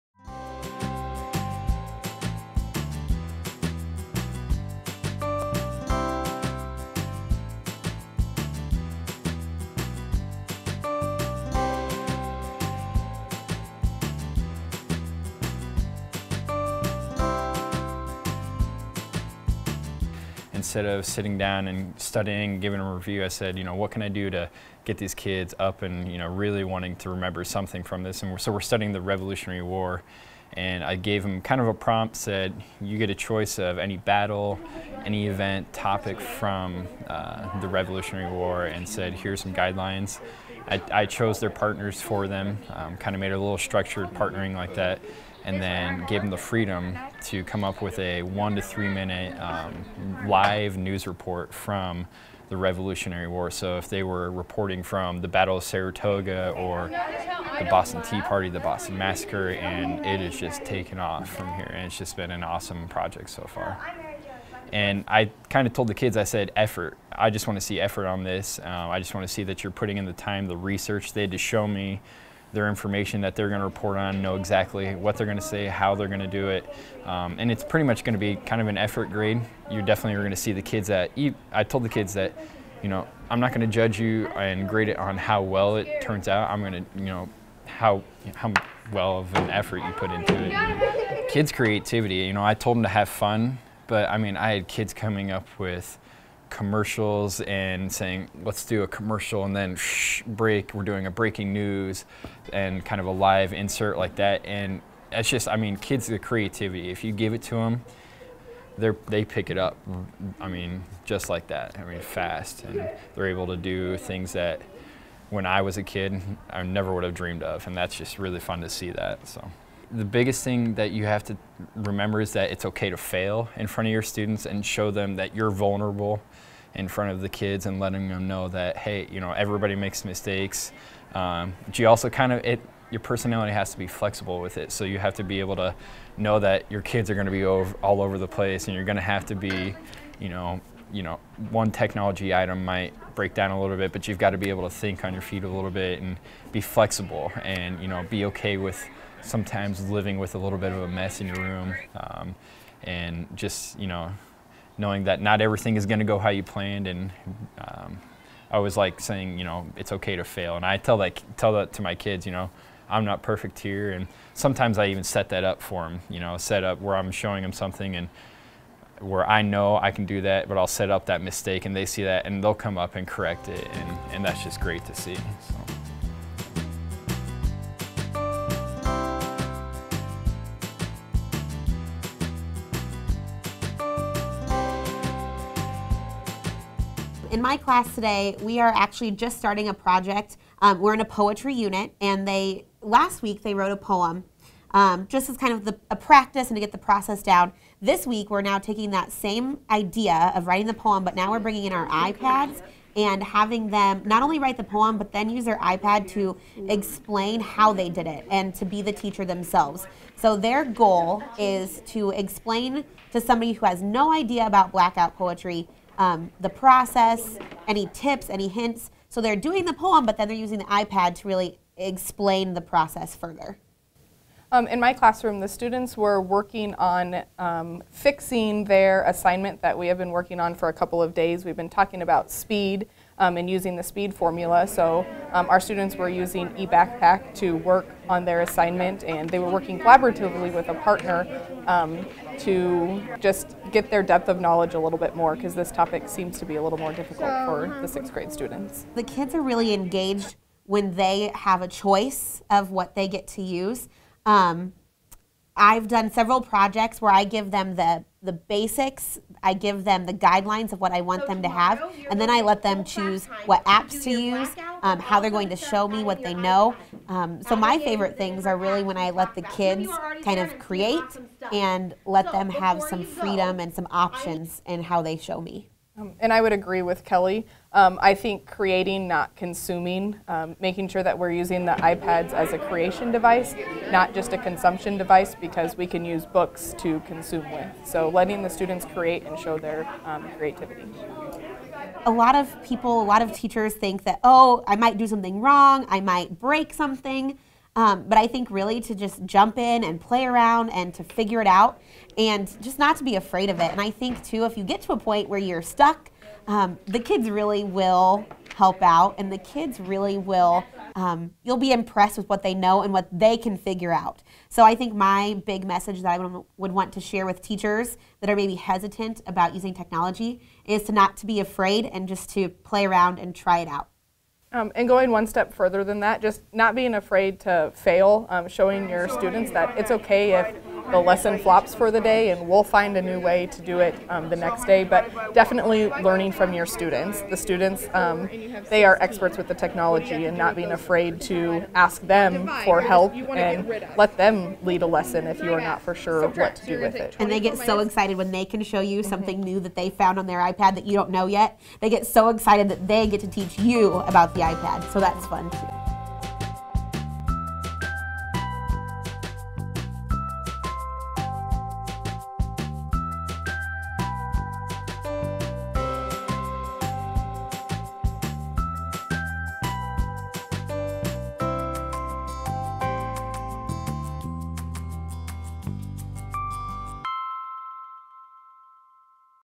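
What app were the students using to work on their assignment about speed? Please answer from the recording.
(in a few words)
eBackpack.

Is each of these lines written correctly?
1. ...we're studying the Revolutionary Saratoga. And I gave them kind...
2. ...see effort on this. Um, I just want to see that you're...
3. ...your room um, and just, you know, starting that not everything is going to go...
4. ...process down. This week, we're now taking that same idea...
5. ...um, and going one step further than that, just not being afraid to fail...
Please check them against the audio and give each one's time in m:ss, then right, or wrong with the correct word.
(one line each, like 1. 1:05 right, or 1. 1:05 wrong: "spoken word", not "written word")
1. 0:28 wrong: "War", not "Saratoga"
2. 1:07 right
3. 2:31 wrong: "knowing", not "starting"
4. 3:16 right
5. 5:24 right.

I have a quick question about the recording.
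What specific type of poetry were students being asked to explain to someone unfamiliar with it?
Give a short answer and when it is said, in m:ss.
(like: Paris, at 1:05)
Blackout poetry, at 3:34.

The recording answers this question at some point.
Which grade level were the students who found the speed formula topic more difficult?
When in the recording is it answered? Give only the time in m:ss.
4:07.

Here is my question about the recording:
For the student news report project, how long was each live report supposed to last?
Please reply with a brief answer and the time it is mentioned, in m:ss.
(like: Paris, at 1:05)
1 to 3 minutes, at 0:48.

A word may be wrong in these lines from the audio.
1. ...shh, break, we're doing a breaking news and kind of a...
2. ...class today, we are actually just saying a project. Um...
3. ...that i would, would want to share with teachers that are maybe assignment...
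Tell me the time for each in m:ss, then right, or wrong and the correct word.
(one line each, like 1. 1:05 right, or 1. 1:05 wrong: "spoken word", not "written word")
1. 1:39 right
2. 3:07 wrong: "starting", not "saying"
3. 5:16 wrong: "hesitant", not "assignment".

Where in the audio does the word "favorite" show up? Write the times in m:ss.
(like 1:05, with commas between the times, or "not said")
4:27.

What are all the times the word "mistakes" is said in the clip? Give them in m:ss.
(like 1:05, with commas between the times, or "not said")
2:10, 2:51.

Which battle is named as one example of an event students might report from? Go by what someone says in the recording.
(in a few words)
Battle of Saratoga.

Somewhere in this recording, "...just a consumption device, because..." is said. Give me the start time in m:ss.
4:44.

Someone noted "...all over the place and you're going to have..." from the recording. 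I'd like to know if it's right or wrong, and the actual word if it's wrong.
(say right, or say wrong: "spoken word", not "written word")
right.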